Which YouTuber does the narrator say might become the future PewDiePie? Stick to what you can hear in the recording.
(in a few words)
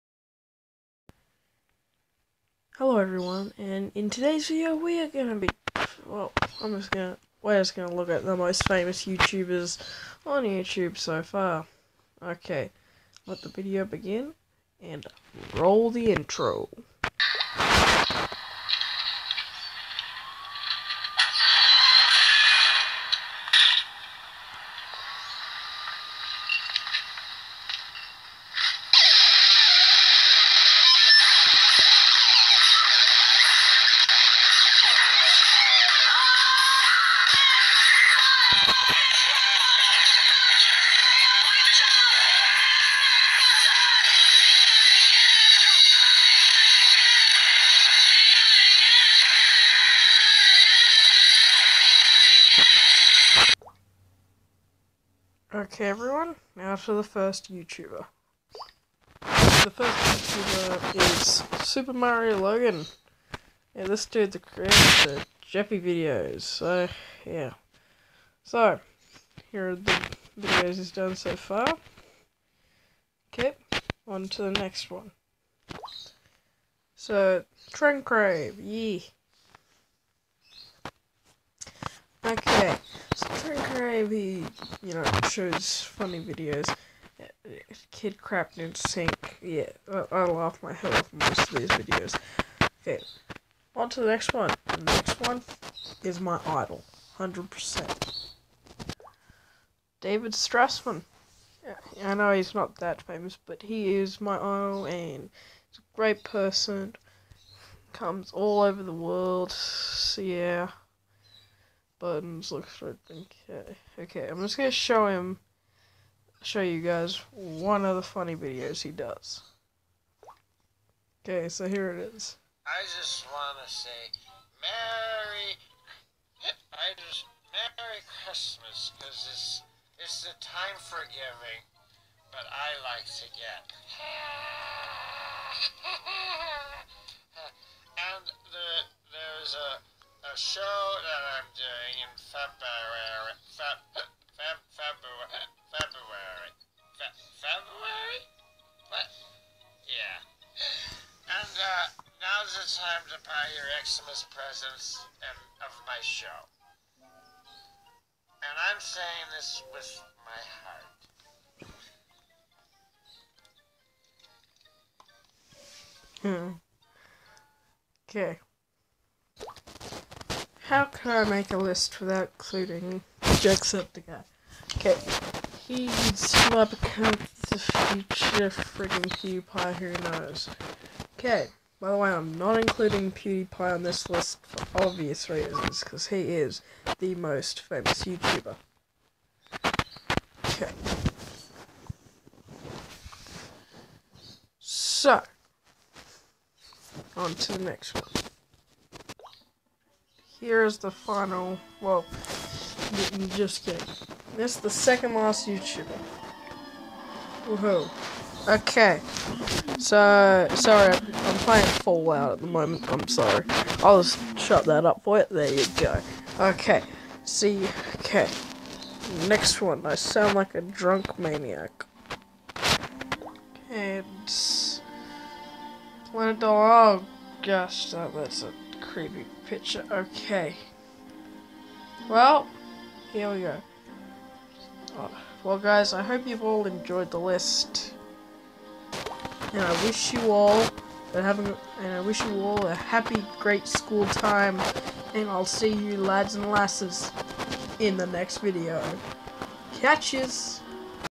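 Jacksepticeye.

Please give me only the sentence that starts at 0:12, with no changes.
Okay, let the video begin, and roll the intro.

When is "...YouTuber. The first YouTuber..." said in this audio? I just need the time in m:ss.
0:57.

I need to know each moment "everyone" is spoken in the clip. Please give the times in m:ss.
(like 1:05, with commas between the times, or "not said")
0:02, 0:55.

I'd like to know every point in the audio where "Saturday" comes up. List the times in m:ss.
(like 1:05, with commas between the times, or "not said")
not said.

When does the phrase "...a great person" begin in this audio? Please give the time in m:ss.
1:45.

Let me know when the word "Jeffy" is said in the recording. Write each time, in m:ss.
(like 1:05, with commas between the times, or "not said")
1:05.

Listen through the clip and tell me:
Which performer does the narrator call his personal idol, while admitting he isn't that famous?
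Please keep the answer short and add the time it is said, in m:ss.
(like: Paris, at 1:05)
David Strassman, at 1:39.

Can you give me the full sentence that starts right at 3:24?
This is the second last YouTuber.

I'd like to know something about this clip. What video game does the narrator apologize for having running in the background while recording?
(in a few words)
Fallout.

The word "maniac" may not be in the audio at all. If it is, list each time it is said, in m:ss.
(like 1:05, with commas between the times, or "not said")
3:41.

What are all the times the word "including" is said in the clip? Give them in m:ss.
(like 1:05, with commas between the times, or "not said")
2:52, 3:02.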